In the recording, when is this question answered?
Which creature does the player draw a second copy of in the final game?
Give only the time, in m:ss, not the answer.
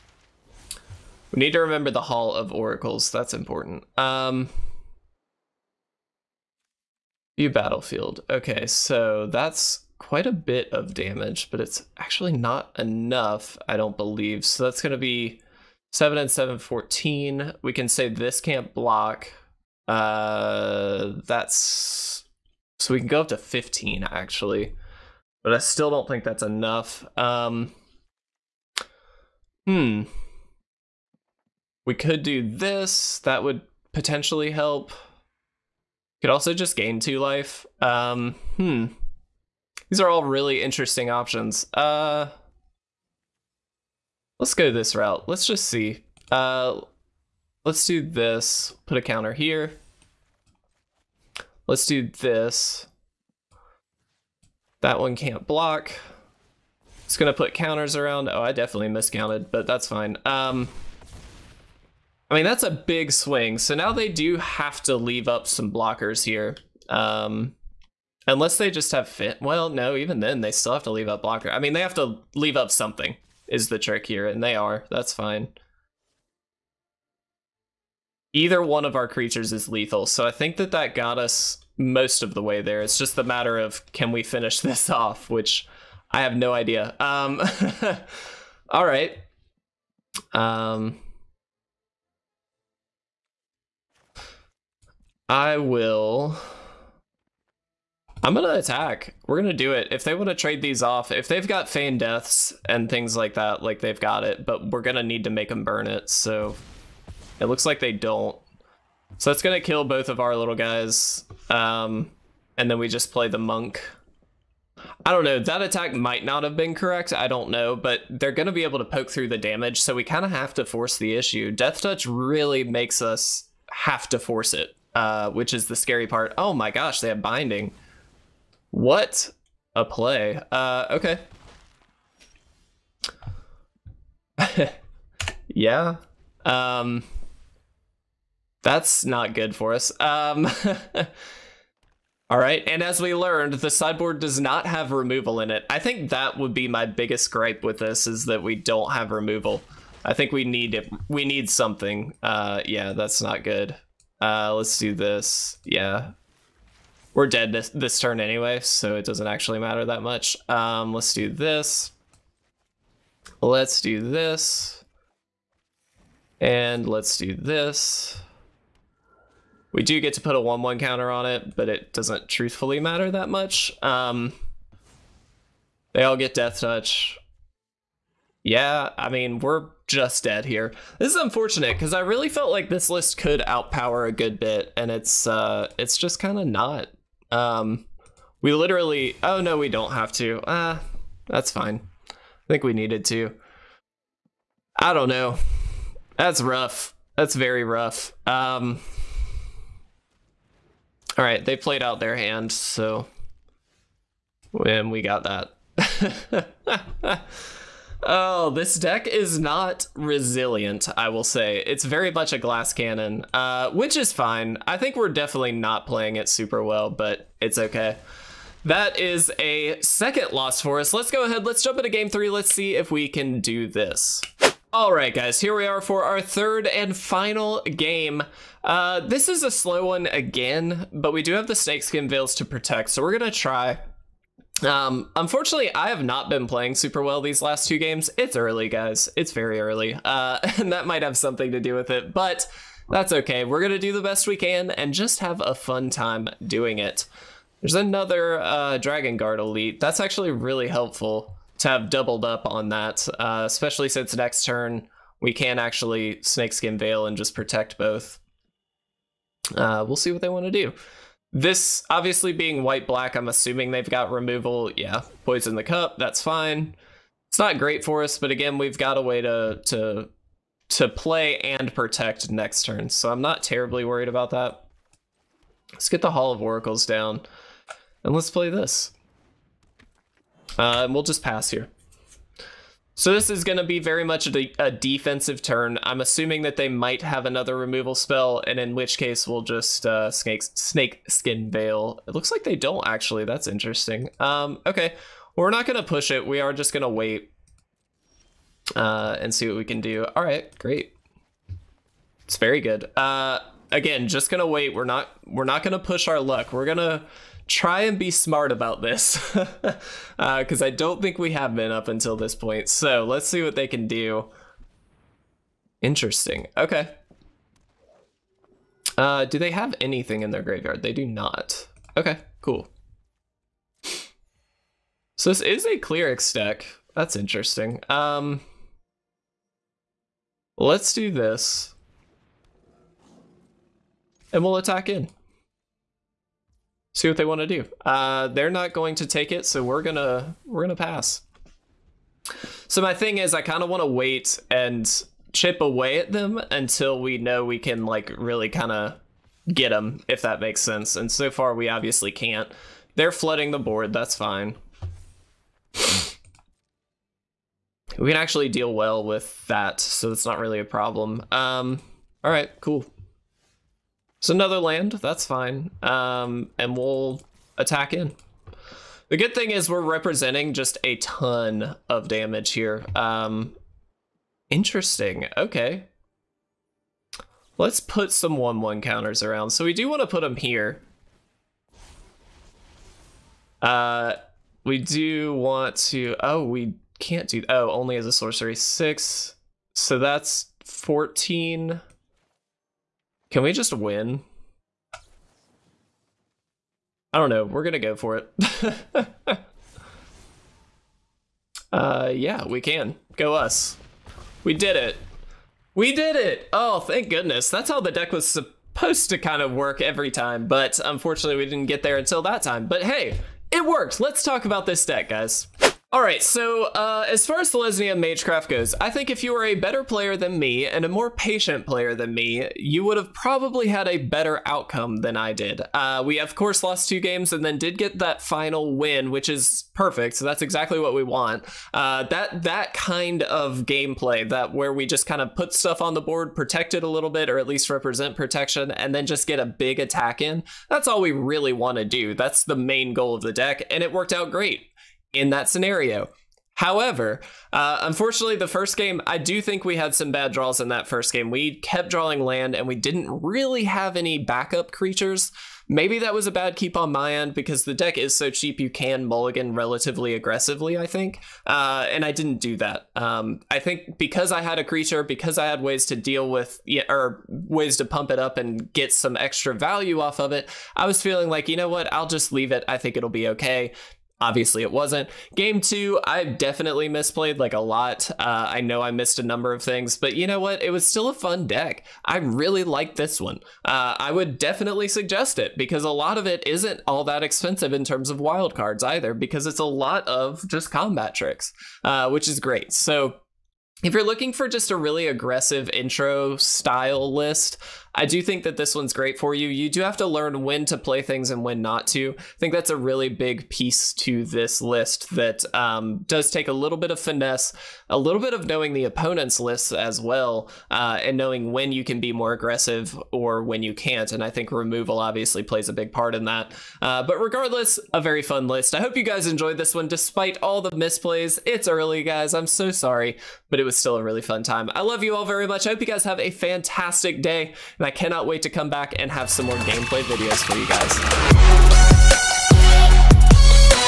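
4:08.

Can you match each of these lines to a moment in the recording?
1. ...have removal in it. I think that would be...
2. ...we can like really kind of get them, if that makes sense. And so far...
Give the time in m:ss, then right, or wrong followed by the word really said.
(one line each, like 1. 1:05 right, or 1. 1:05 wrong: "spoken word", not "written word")
1. 2:24 right
2. 5:47 right.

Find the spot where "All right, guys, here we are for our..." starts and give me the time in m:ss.
3:44.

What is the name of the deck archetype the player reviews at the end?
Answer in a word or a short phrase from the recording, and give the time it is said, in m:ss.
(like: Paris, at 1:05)
Selesnya Magecraft, at 6:57.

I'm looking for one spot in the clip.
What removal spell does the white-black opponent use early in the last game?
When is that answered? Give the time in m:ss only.
4:25.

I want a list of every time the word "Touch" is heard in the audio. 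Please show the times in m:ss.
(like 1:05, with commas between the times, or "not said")
2:01, 2:56.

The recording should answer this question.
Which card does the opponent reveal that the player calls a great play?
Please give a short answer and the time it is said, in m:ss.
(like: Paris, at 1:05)
binding, at 2:07.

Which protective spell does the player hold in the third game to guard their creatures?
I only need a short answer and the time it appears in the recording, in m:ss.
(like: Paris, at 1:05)
Snakeskin Veil, at 3:51.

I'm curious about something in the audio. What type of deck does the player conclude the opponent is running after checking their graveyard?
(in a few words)
cleric deck.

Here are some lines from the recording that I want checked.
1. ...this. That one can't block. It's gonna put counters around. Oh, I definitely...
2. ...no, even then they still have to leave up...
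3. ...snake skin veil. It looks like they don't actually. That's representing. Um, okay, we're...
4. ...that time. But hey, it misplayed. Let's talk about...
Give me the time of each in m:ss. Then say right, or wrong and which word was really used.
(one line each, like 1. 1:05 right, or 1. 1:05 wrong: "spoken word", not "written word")
1. 0:52 right
2. 1:09 right
3. 4:50 wrong: "interesting", not "representing"
4. 6:52 wrong: "worked", not "misplayed".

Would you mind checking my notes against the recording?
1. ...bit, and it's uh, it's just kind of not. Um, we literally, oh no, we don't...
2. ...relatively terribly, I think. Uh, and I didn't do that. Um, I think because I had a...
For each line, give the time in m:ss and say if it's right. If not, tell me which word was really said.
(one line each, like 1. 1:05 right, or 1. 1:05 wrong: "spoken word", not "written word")
1. 3:04 right
2. 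7:39 wrong: "aggressively", not "terribly".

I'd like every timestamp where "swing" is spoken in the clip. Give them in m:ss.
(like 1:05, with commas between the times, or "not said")
1:03.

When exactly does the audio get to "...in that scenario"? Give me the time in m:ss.
7:25.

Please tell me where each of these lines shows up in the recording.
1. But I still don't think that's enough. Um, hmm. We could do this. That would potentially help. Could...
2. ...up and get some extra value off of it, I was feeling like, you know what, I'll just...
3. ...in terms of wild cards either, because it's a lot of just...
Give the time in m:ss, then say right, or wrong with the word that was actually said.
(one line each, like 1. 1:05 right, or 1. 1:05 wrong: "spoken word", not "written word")
1. 0:25 right
2. 7:48 right
3. 8:07 right.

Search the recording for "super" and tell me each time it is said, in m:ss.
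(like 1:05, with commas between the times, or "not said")
3:36, 3:56.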